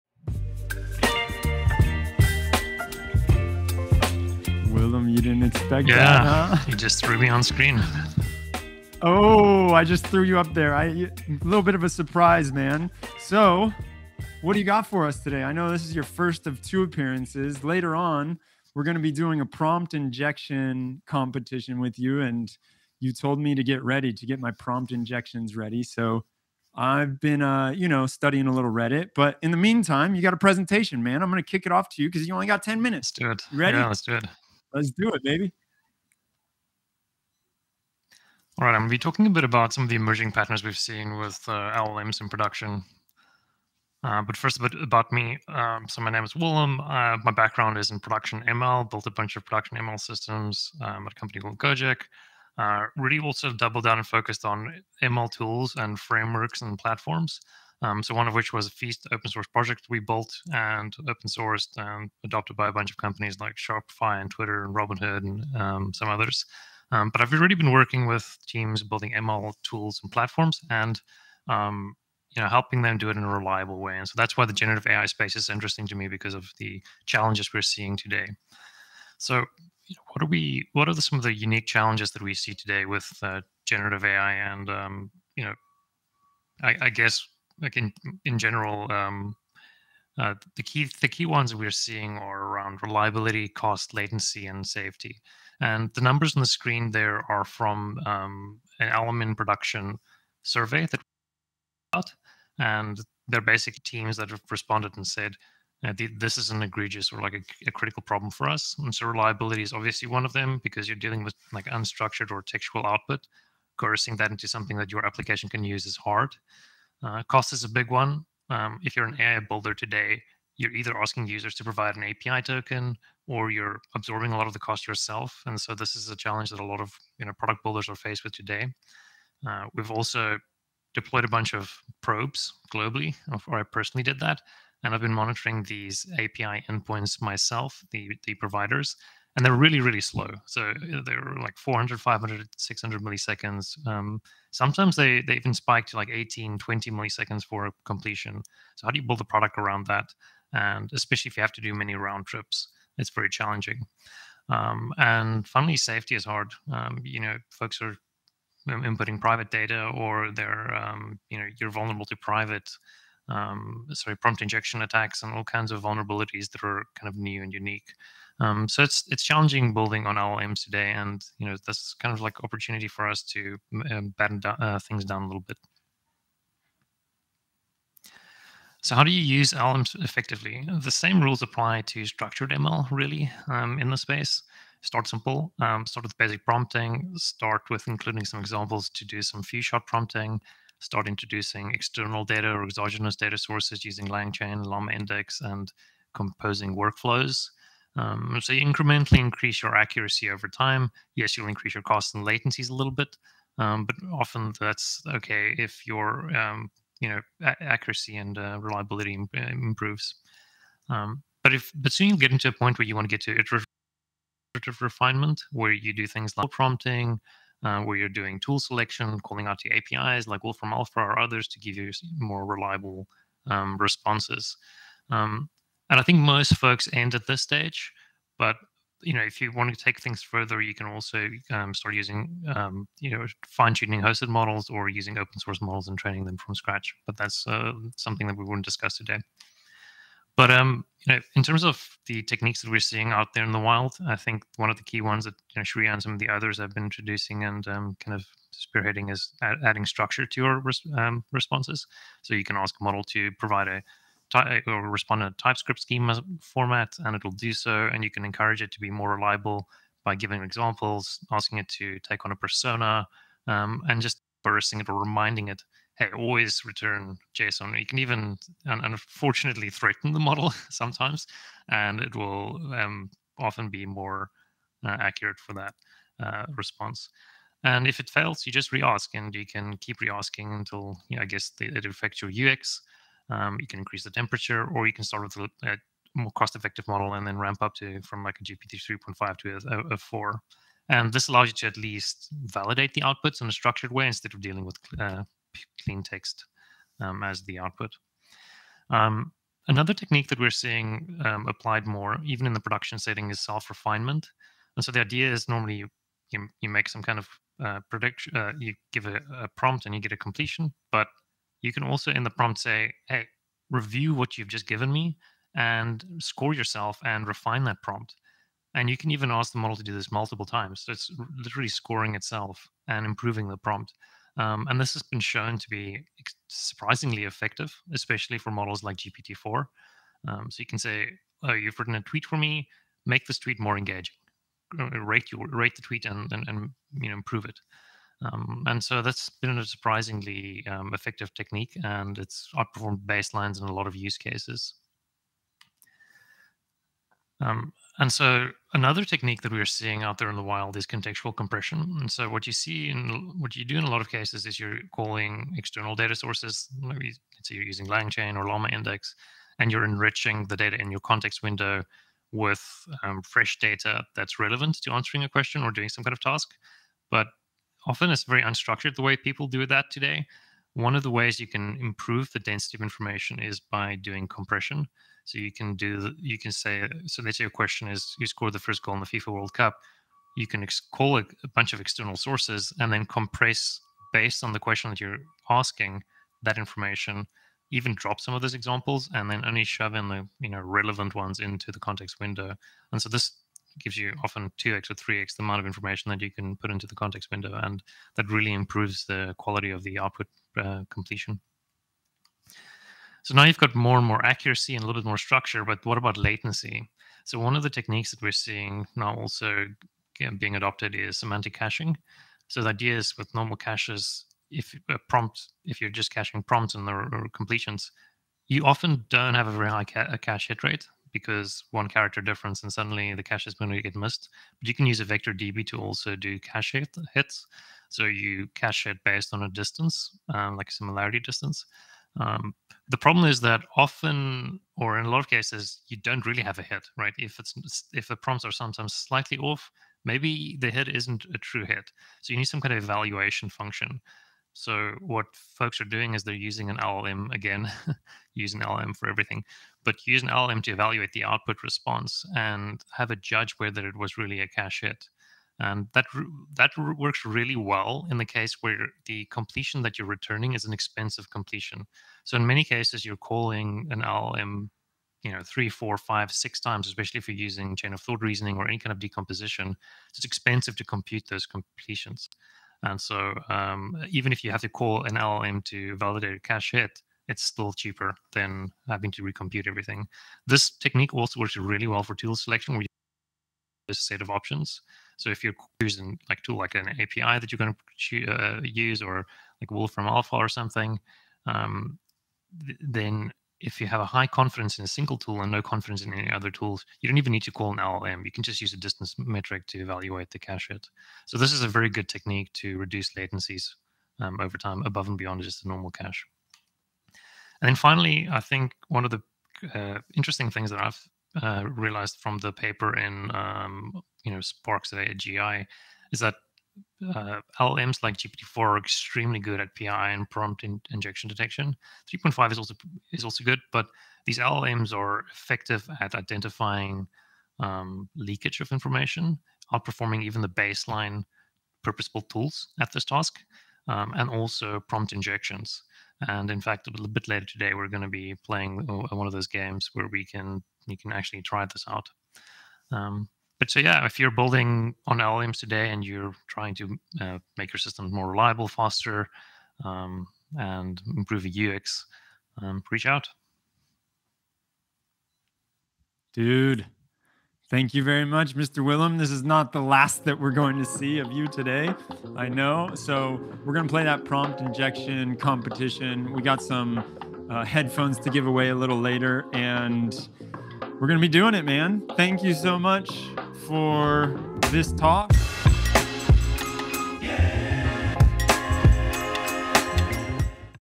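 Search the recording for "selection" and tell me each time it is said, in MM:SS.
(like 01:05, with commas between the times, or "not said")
03:38, 08:02.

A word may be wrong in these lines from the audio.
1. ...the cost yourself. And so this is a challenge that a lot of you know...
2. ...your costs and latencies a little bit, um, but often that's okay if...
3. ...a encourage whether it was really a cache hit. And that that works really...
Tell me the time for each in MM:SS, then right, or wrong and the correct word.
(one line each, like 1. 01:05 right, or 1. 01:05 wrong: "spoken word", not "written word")
1. 02:04 right
2. 03:21 right
3. 07:33 wrong: "judge", not "encourage".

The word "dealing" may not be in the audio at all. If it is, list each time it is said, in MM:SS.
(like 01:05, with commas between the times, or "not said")
01:50, 04:54.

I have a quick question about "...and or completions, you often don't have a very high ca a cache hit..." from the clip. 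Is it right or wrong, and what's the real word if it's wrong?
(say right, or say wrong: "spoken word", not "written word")
right.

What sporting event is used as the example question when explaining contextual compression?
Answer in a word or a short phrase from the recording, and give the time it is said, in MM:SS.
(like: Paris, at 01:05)
FIFA World Cup, at 06:19.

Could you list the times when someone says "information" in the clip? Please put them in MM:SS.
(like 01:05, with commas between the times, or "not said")
06:12, 06:26, 06:35, 08:48.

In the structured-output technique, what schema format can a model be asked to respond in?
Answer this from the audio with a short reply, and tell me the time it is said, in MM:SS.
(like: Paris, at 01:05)
TypeScript, at 04:15.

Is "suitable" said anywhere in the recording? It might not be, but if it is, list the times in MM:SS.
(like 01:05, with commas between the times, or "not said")
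not said.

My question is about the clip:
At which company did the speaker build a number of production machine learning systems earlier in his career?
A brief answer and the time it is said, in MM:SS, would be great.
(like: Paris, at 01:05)
Gojek, at 00:51.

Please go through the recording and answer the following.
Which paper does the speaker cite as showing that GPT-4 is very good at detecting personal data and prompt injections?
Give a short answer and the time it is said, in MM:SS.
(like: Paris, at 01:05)
Sparks of AGI, at 08:34.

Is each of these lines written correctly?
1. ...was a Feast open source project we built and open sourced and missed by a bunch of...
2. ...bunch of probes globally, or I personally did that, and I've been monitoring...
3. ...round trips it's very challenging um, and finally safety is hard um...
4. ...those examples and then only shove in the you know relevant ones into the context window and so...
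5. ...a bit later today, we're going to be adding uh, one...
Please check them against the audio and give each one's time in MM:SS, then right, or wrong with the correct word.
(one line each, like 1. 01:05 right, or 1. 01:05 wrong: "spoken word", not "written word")
1. 00:58 wrong: "adopted", not "missed"
2. 02:11 right
3. 02:31 right
4. 06:28 right
5. 08:56 wrong: "playing", not "adding".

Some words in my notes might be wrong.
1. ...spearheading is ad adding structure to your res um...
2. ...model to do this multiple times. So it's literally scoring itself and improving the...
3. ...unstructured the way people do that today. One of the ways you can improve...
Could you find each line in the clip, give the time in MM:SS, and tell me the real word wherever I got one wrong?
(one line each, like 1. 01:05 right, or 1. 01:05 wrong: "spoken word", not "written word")
1. 04:08 right
2. 05:19 right
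3. 06:08 right.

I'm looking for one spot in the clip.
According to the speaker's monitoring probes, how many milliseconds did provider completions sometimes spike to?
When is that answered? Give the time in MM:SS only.
02:26.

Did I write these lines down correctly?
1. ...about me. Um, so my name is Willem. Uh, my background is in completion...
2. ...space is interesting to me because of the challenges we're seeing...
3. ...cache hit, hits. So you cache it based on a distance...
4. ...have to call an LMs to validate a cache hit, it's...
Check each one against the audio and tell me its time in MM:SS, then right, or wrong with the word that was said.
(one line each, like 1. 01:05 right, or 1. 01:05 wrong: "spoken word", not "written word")
1. 00:44 wrong: "production", not "completion"
2. 01:15 right
3. 07:06 right
4. 07:54 wrong: "LLM", not "LMs".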